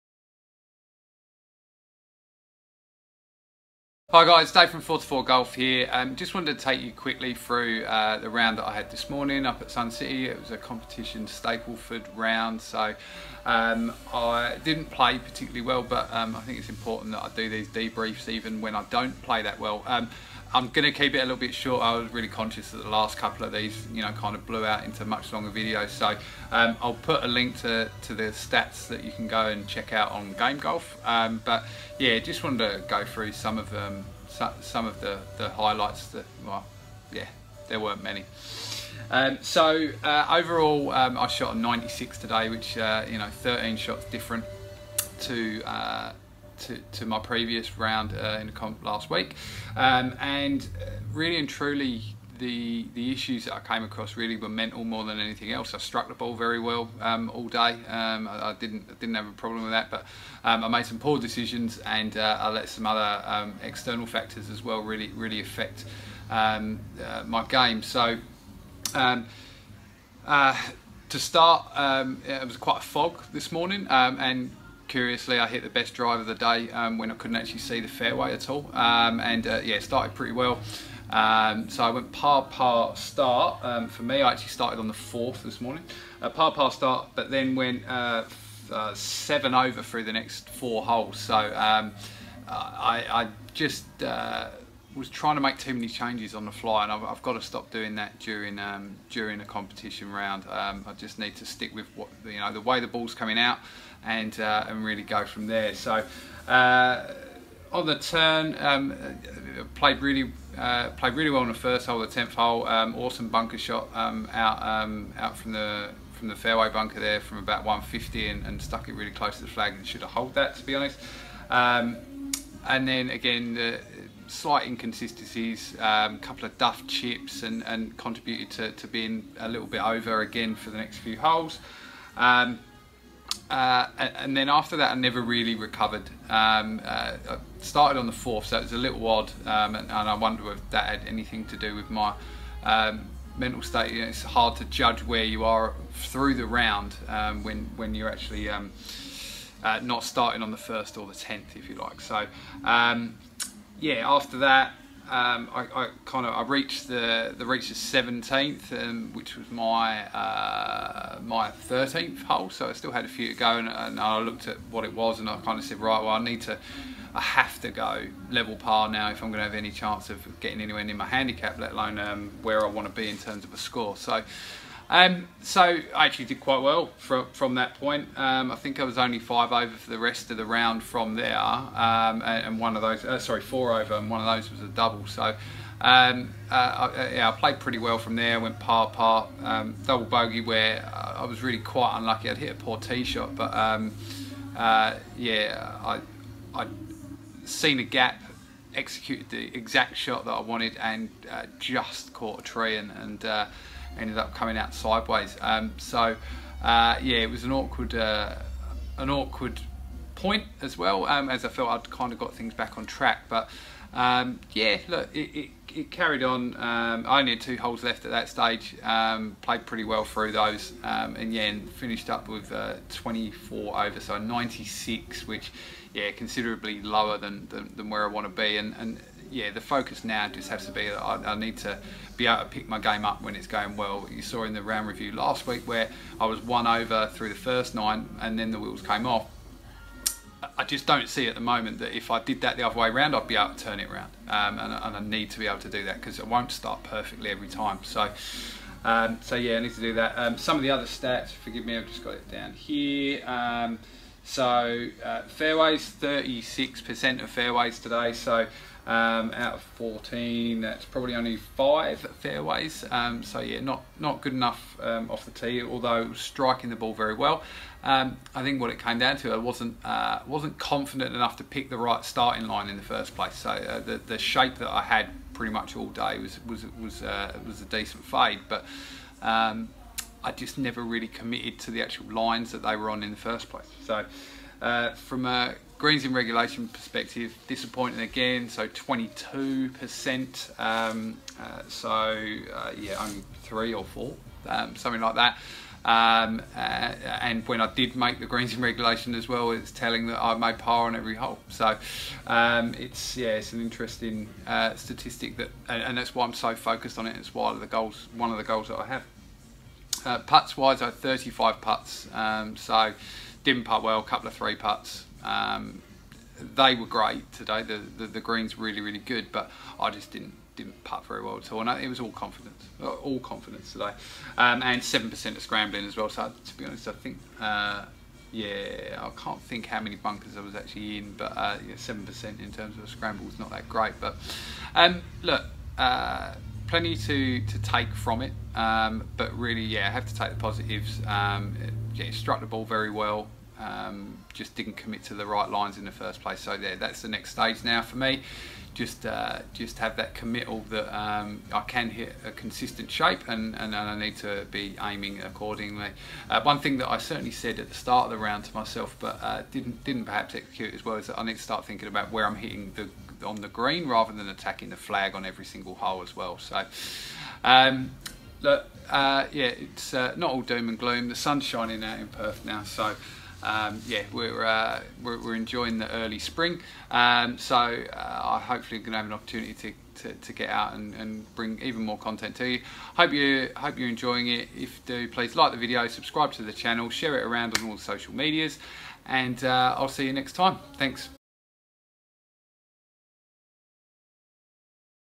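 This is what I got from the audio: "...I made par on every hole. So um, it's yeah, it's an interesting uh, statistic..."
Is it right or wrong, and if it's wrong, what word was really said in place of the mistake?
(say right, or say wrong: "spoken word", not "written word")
right.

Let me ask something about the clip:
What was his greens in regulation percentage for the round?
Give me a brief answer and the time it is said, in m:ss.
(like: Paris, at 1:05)
22%, at 4:48.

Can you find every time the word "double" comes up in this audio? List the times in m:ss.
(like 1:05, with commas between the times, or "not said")
3:04, 3:09.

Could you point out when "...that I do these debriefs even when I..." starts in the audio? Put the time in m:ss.
0:17.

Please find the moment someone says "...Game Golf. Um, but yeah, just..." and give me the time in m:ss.
0:30.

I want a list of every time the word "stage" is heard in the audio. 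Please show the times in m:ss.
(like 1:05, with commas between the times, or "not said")
3:38, 5:47.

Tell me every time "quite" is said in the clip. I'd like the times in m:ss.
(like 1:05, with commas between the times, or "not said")
1:12, 2:56, 3:11.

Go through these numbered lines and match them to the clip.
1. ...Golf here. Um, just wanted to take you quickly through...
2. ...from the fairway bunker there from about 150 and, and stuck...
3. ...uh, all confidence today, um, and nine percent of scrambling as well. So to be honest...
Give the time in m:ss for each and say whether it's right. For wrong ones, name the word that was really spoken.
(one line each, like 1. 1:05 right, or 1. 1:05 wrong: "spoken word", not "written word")
1. 0:05 right
2. 1:56 right
3. 5:22 wrong: "seven", not "nine".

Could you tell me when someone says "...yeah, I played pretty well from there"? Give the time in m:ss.
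3:07.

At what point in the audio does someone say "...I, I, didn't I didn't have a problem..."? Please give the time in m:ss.
0:58.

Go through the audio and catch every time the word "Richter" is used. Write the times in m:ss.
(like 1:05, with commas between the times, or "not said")
not said.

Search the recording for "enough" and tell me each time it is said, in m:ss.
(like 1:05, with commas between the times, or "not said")
4:24, 4:31.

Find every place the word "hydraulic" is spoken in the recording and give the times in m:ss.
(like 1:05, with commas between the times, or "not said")
not said.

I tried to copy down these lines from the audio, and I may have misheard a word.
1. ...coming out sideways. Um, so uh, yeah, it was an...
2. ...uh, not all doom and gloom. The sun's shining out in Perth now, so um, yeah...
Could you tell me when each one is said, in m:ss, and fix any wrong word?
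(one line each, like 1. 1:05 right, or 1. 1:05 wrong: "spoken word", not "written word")
1. 3:24 right
2. 6:09 right.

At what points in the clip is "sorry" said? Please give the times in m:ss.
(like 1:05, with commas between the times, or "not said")
3:03.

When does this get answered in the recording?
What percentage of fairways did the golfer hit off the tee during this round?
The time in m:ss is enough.
4:16.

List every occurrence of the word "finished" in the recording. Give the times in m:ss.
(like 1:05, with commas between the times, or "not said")
3:41.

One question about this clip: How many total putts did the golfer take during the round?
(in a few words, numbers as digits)
35.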